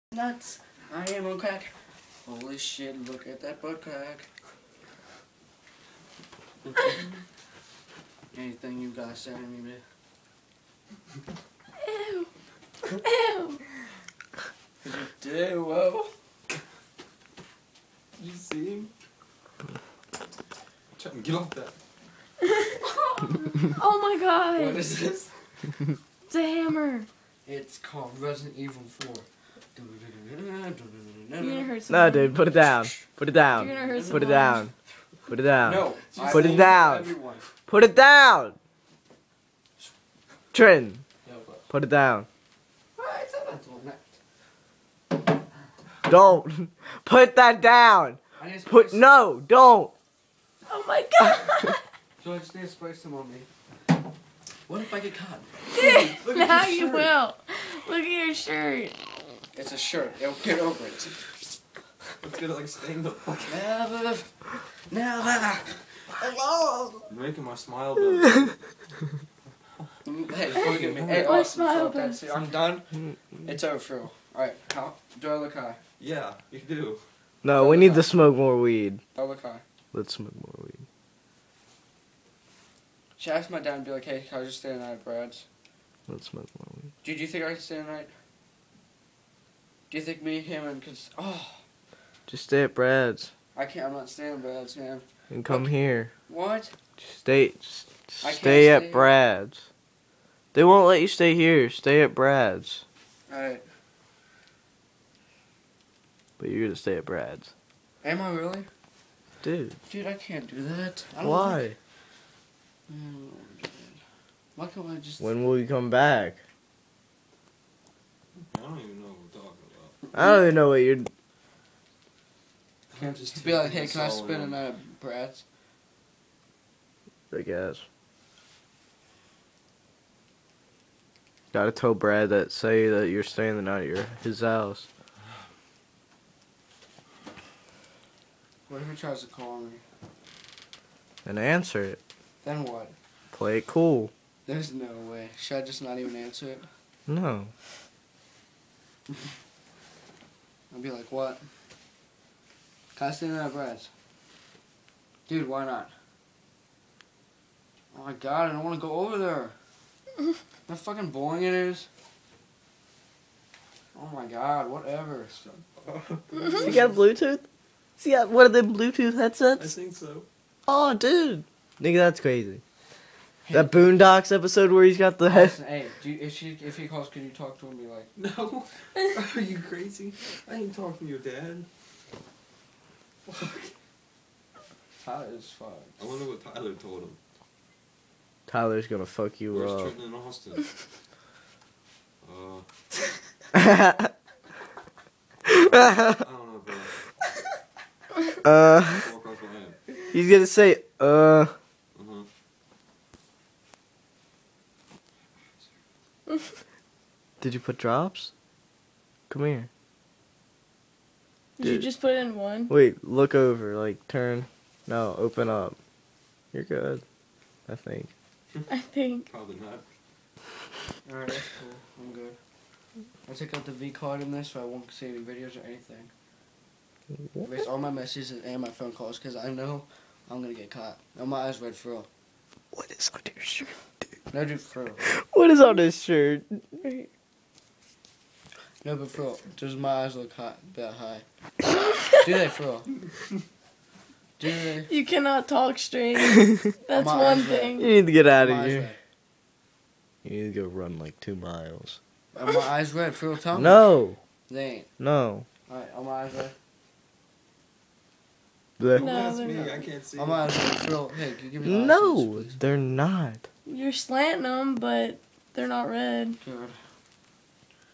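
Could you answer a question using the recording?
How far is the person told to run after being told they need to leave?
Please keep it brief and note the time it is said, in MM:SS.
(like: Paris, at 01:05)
2 miles, at 04:11.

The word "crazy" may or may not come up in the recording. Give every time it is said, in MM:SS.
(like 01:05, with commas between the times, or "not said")
02:52, 02:59.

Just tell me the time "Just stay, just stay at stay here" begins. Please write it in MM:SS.
01:36.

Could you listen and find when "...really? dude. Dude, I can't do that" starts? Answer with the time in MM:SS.
01:48.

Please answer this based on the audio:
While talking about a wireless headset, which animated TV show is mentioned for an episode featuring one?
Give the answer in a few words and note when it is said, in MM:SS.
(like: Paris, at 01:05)
Boondocks, at 02:53.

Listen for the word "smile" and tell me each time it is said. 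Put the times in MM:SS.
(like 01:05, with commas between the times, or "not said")
01:07, 01:11.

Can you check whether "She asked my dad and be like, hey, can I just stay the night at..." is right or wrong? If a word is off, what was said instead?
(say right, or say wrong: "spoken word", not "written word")
right.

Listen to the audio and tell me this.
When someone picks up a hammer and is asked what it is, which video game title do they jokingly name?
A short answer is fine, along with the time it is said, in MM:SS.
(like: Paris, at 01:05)
Resident Evil 4, at 00:28.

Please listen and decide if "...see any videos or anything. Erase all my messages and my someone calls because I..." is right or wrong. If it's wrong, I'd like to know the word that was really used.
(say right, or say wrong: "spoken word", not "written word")
wrong: "phone", not "someone".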